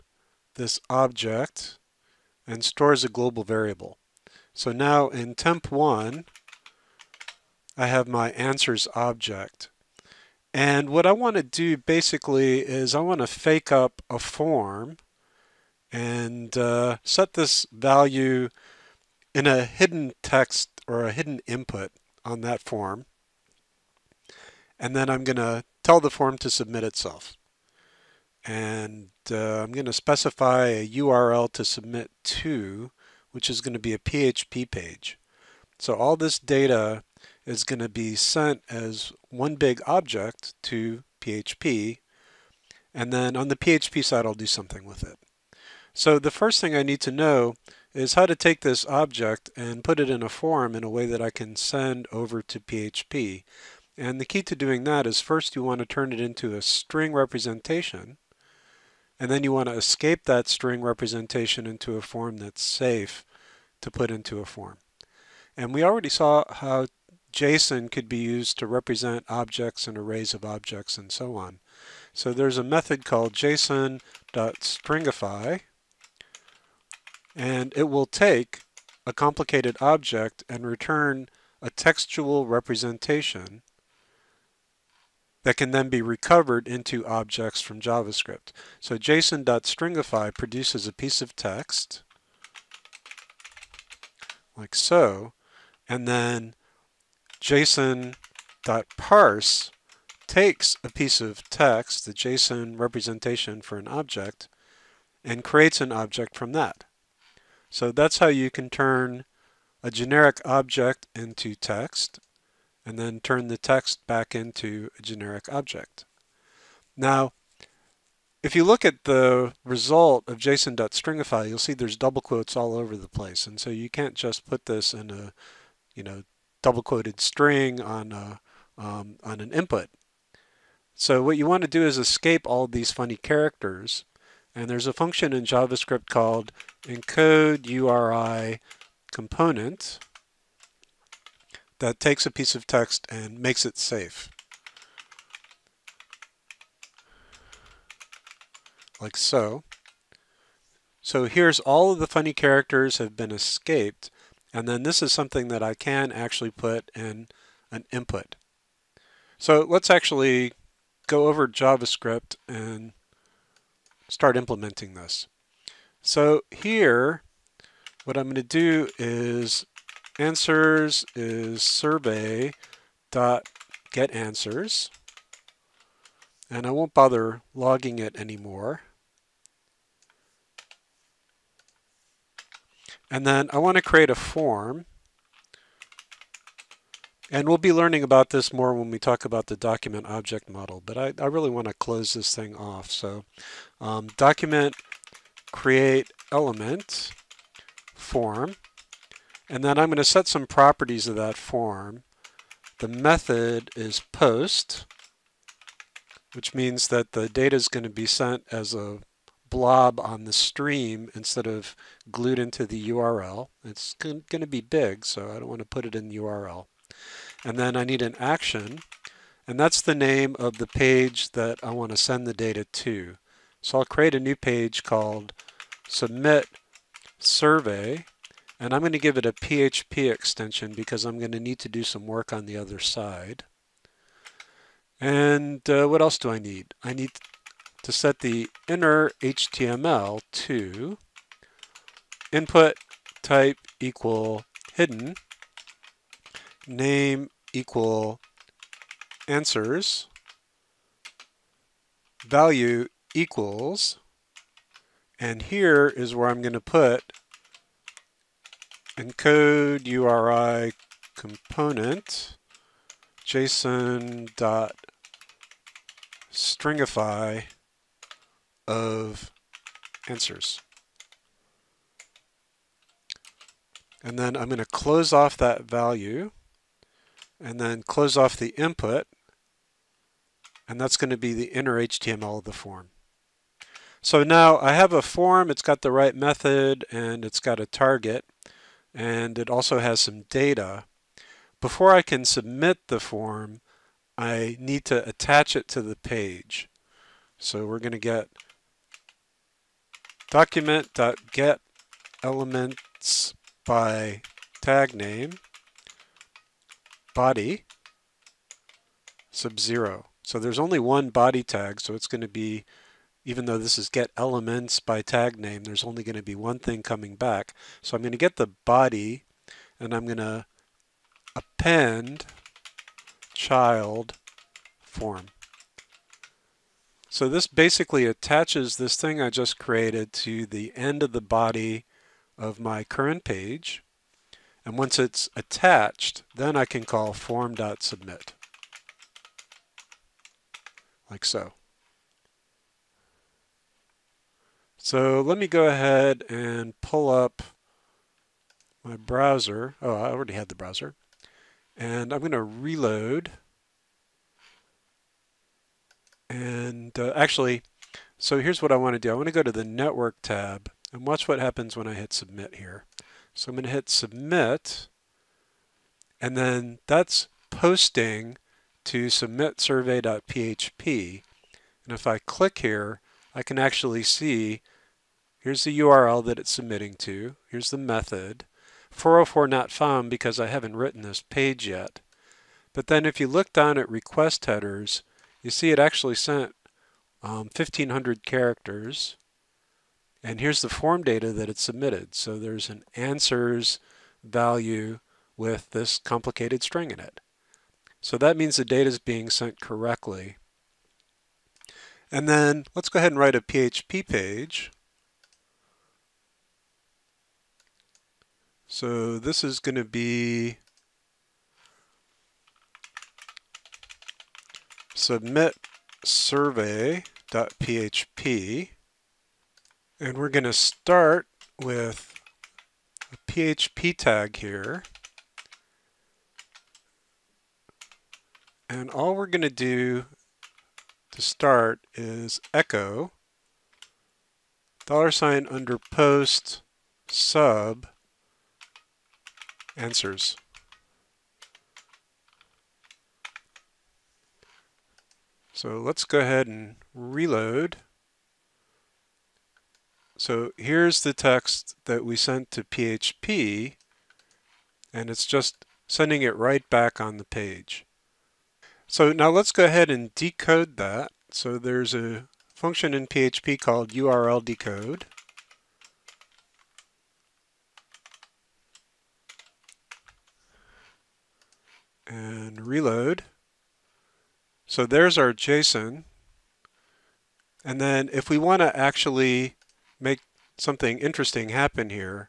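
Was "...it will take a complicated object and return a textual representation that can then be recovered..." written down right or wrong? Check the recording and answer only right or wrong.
right.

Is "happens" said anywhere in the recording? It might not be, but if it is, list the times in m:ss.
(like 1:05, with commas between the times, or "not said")
6:01, 8:01.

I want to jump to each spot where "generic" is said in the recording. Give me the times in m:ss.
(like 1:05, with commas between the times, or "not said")
1:49, 1:55.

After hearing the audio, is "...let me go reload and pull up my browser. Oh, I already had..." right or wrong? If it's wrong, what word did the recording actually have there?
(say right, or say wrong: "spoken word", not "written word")
wrong: "ahead", not "reload".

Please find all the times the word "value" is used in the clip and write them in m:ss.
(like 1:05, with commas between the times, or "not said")
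0:17, 4:12, 4:35, 6:34.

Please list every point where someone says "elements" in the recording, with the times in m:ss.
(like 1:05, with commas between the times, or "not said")
3:16, 5:02, 5:14.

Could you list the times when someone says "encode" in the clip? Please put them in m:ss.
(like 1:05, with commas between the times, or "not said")
2:16, 4:19.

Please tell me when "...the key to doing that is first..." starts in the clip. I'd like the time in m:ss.
0:54.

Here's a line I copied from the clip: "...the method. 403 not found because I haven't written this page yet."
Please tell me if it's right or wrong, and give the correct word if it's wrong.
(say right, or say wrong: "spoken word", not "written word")
wrong: "404", not "403".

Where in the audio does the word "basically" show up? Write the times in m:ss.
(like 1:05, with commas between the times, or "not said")
0:11, 5:27.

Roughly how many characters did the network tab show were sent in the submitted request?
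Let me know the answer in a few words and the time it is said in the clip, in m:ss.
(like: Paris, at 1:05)
1500, at 6:27.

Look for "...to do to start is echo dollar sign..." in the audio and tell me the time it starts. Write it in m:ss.
7:09.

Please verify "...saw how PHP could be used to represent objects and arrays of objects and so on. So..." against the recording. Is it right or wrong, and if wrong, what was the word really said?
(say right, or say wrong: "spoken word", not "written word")
wrong: "JSON", not "PHP".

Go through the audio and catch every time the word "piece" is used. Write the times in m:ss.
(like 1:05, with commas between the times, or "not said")
1:30, 1:40, 2:22.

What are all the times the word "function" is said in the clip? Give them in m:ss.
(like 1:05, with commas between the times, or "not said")
2:14, 7:42.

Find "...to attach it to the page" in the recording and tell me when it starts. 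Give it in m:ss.
4:54.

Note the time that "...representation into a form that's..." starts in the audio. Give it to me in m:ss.
1:00.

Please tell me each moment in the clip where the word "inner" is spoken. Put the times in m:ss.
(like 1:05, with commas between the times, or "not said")
3:58, 4:41.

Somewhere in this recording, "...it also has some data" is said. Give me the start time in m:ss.
4:49.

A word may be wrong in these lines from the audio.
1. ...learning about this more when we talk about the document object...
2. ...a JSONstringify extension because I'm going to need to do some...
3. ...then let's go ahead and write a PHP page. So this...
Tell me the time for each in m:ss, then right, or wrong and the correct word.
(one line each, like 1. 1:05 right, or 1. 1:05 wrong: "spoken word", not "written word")
1. 3:07 right
2. 3:49 wrong: "PHP", not "JSONstringify"
3. 6:42 right.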